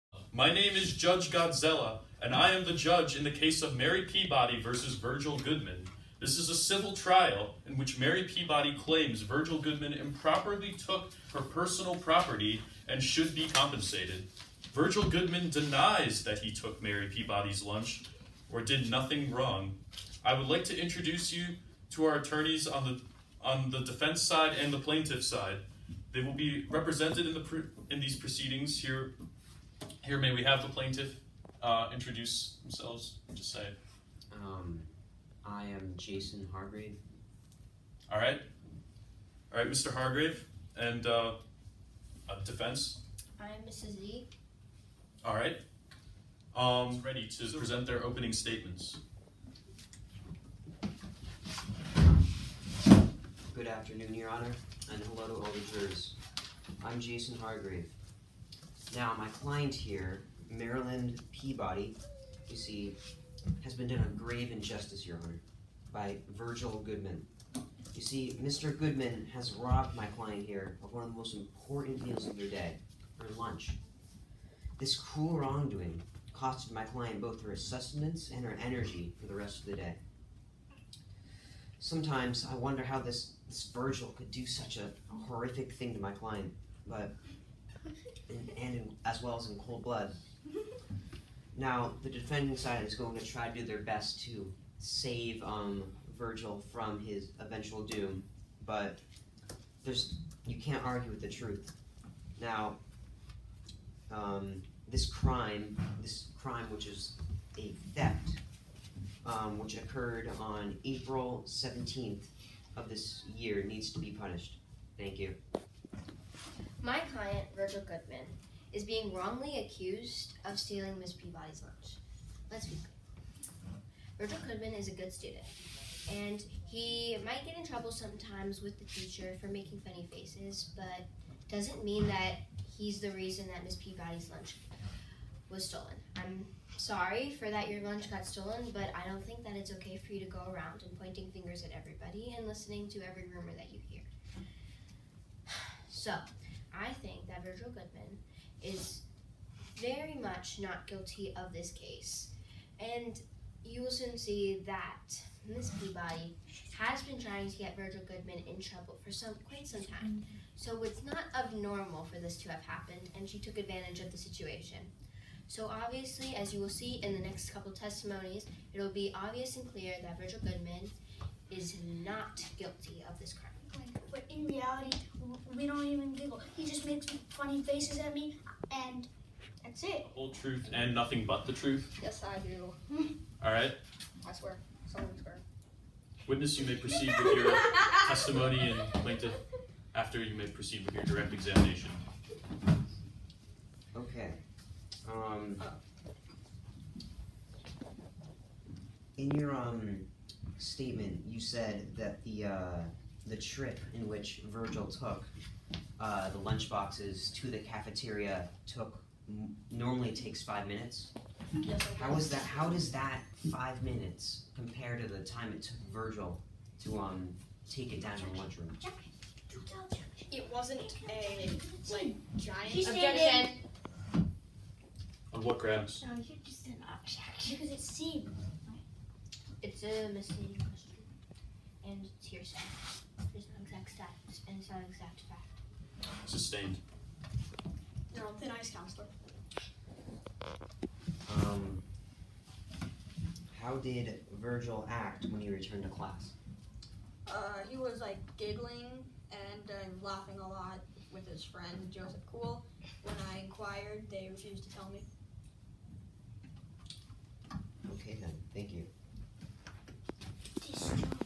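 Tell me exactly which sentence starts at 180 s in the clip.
The whole truth and nothing but the truth?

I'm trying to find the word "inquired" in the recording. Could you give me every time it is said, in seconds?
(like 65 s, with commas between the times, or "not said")
253 s.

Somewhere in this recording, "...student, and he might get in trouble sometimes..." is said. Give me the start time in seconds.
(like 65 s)
125 s.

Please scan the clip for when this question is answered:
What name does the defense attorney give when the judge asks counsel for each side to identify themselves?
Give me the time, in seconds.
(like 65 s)
43 s.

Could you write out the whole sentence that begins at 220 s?
It wasn't a like giant objection.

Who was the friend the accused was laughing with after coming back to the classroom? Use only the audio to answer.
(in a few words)
Joseph Cool.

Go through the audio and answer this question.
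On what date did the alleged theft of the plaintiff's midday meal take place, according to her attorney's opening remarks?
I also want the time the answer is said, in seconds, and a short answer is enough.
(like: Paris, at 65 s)
April 17th, at 110 s.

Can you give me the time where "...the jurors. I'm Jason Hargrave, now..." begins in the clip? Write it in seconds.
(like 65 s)
55 s.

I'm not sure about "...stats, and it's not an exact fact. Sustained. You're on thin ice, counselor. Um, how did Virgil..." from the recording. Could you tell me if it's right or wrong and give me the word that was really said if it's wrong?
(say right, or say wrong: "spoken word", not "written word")
right.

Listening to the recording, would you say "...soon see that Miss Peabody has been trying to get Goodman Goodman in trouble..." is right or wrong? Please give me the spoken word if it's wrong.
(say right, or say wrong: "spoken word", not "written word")
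wrong: "Virgil", not "Goodman".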